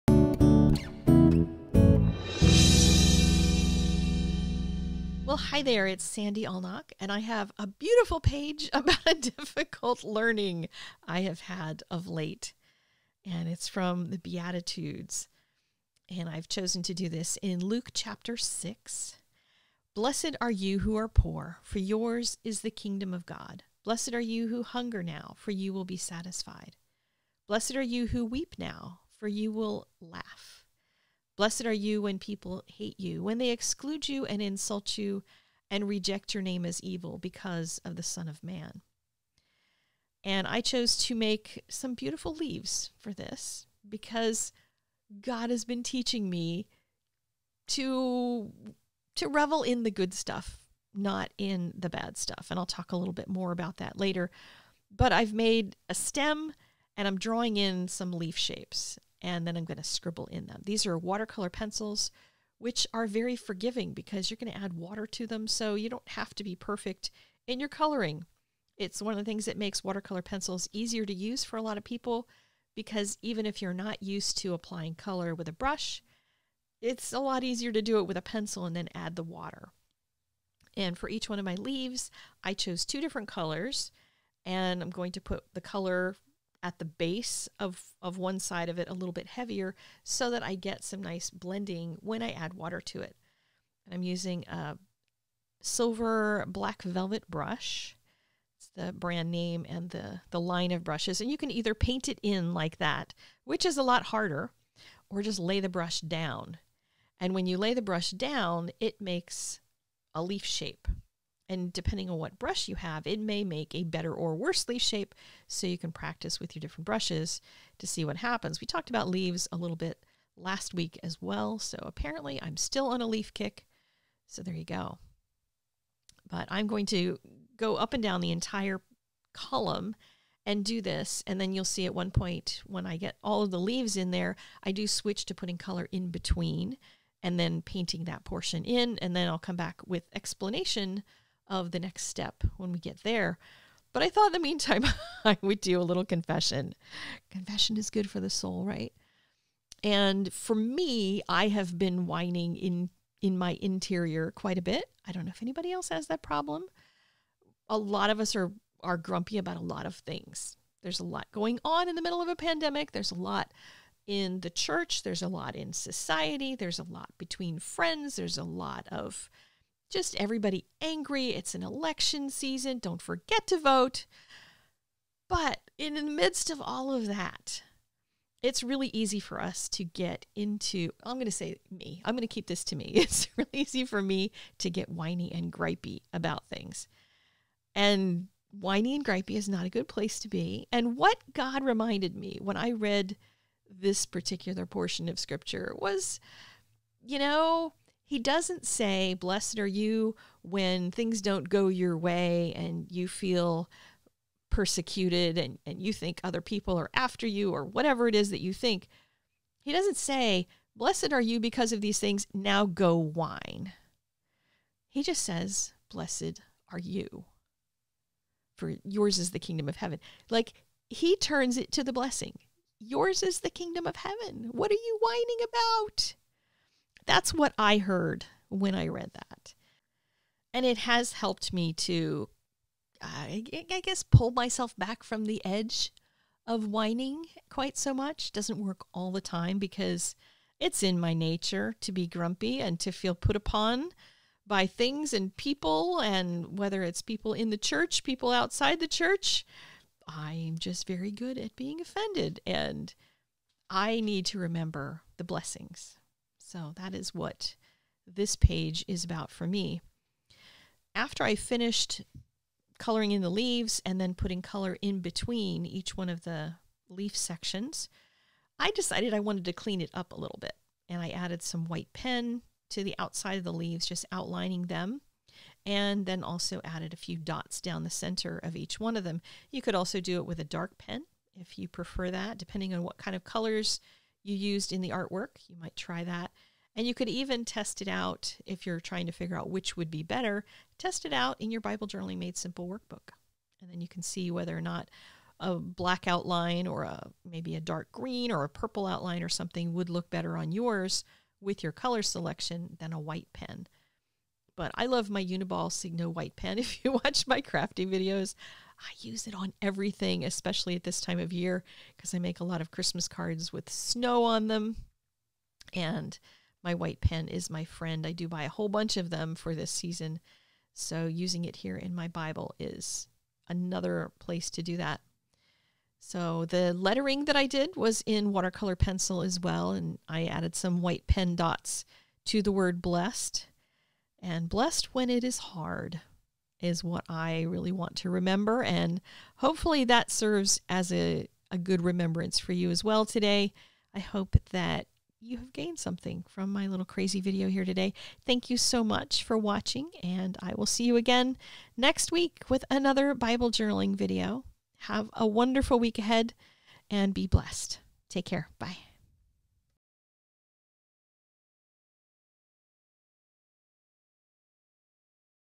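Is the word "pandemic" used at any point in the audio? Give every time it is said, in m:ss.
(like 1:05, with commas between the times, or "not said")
2:42.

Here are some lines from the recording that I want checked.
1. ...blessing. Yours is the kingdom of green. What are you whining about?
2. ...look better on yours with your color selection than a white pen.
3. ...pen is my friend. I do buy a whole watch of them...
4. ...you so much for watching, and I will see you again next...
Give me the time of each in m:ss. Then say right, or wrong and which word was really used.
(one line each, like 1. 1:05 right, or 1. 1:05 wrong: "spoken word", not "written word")
1. 3:41 wrong: "heaven", not "green"
2. 4:59 right
3. 5:17 wrong: "bunch", not "watch"
4. 5:48 right.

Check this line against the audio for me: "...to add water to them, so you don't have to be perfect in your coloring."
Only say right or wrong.
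right.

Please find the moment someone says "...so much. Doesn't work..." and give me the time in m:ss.
3:57.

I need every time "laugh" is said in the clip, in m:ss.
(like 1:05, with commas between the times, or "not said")
0:30.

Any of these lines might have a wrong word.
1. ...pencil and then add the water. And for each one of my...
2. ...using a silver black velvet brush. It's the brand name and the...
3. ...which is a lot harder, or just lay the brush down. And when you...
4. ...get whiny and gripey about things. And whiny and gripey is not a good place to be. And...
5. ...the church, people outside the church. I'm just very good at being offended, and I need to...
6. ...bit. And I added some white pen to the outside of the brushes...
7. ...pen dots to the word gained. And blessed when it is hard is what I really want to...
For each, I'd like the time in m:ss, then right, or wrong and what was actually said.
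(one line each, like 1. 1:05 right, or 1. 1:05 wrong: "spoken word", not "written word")
1. 1:18 right
2. 1:34 right
3. 1:43 right
4. 3:04 right
5. 4:07 right
6. 4:30 wrong: "leaves", not "brushes"
7. 5:31 wrong: "blessed", not "gained".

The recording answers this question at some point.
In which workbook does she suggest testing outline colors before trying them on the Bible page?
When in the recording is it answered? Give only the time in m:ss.
4:51.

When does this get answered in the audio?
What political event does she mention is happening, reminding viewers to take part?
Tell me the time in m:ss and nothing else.
2:51.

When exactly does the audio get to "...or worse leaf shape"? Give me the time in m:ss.
1:54.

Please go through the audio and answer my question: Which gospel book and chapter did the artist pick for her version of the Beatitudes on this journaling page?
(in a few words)
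Luke 6.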